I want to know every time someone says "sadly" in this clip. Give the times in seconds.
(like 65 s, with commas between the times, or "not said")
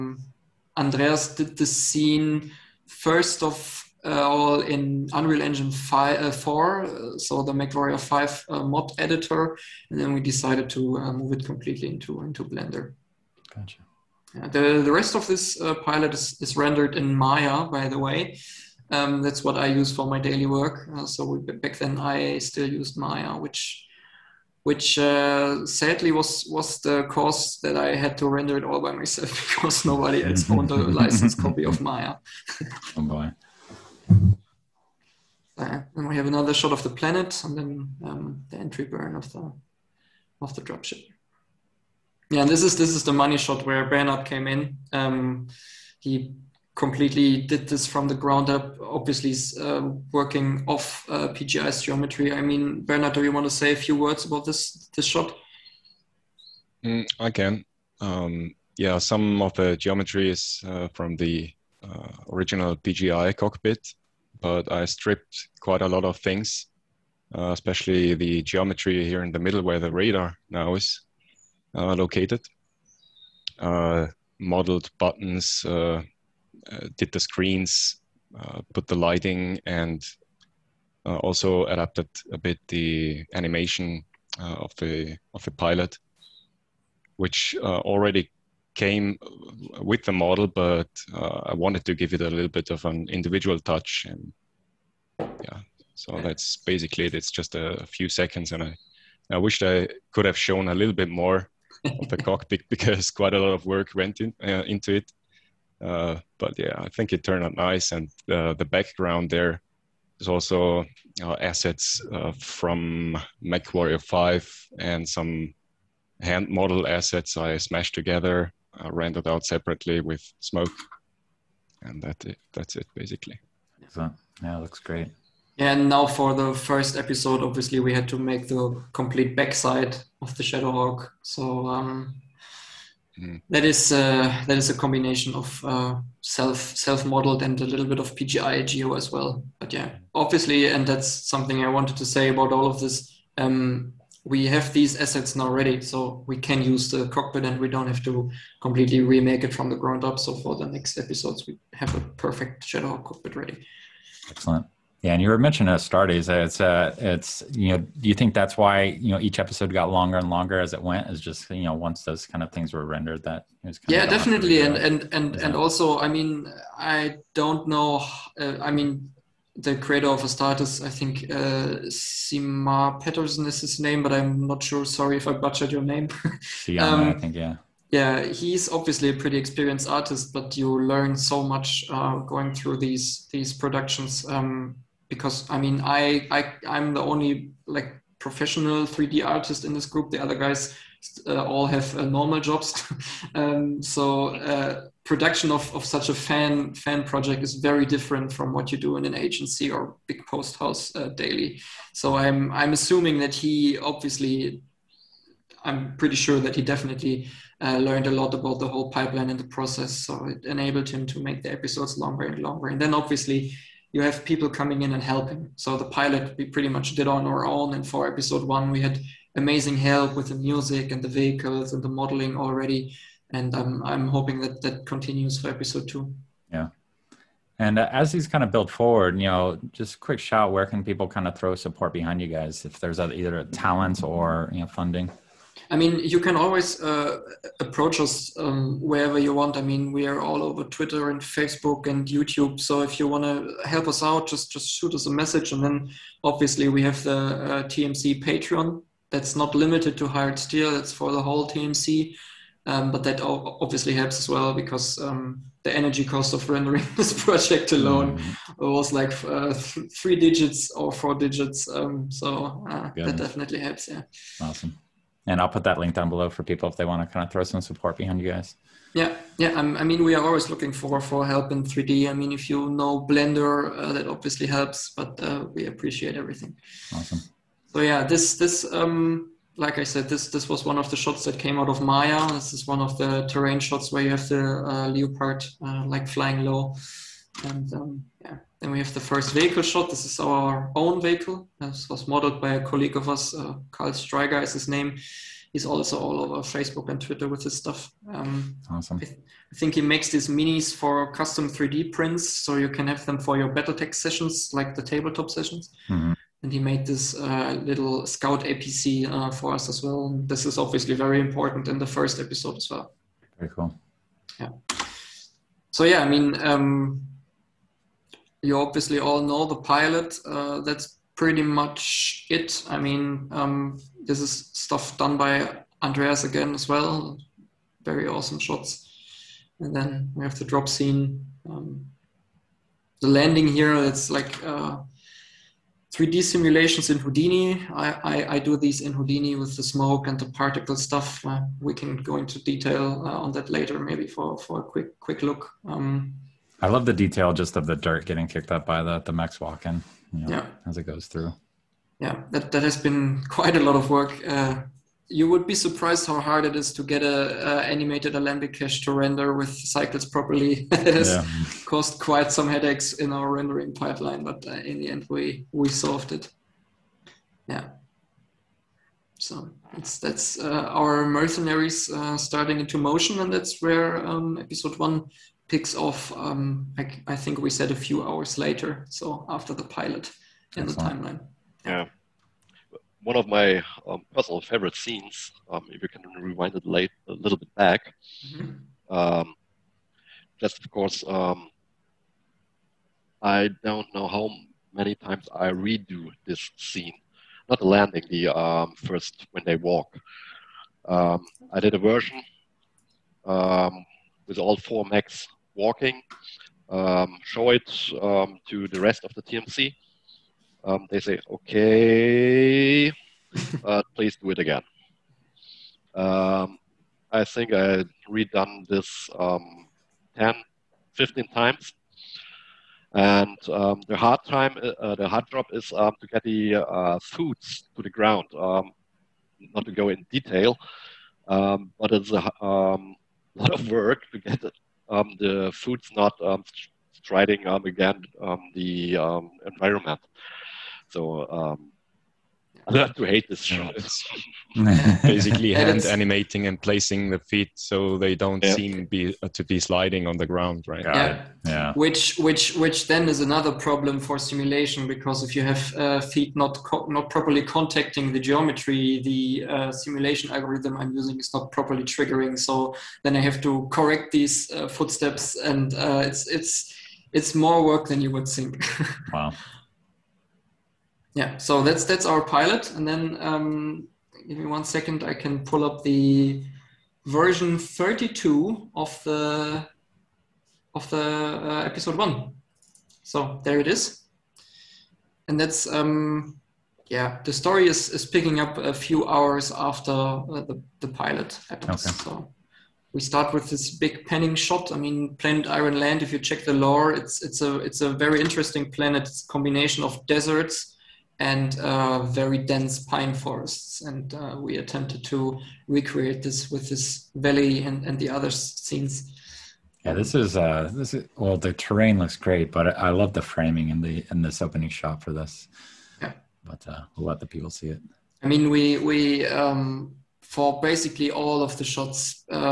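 25 s.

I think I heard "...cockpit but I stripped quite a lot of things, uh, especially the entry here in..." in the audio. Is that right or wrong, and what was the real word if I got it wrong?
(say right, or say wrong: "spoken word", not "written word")
wrong: "geometry", not "entry".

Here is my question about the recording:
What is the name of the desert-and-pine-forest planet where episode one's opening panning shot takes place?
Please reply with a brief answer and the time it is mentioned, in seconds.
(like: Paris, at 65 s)
Iron Land, at 495 s.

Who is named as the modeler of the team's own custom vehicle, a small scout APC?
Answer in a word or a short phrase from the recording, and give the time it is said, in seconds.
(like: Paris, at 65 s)
Karl Streiger, at 293 s.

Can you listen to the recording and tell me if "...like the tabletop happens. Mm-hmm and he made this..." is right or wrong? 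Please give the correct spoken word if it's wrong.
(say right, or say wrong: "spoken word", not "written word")
wrong: "sessions", not "happens".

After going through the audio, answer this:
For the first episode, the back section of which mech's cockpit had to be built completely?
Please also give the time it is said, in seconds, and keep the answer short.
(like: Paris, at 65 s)
Shadowhawk, at 130 s.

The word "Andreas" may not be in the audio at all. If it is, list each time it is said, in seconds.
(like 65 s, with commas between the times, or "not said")
0 s, 325 s.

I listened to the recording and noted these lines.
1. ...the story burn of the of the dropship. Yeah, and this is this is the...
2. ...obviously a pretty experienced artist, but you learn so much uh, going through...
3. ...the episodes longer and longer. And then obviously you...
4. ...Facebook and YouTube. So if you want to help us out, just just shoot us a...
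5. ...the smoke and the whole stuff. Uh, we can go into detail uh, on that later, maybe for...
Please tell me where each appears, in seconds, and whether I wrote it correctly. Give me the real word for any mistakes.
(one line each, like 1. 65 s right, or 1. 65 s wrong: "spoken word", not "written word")
1. 38 s wrong: "entry", not "story"
2. 178 s right
3. 211 s right
4. 241 s right
5. 339 s wrong: "particle", not "whole".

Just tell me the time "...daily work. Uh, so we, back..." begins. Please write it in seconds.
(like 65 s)
20 s.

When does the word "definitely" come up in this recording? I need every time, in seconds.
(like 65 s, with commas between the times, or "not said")
164 s, 206 s, 263 s.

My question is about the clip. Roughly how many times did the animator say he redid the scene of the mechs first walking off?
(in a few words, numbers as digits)
10 to 15.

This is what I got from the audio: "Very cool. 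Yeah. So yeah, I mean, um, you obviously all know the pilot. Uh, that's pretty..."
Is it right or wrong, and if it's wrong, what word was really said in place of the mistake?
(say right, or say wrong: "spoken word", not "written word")
right.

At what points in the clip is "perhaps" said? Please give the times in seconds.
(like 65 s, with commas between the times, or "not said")
not said.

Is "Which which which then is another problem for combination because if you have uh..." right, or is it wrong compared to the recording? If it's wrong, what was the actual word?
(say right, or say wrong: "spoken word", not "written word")
wrong: "simulation", not "combination".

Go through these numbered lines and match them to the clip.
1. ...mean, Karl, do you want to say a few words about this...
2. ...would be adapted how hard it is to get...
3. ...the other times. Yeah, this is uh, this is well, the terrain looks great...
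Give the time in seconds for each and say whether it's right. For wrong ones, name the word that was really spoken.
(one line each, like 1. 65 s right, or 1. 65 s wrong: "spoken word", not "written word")
1. 52 s wrong: "Bernhard", not "Karl"
2. 355 s wrong: "surprised", not "adapted"
3. 507 s wrong: "scenes", not "times".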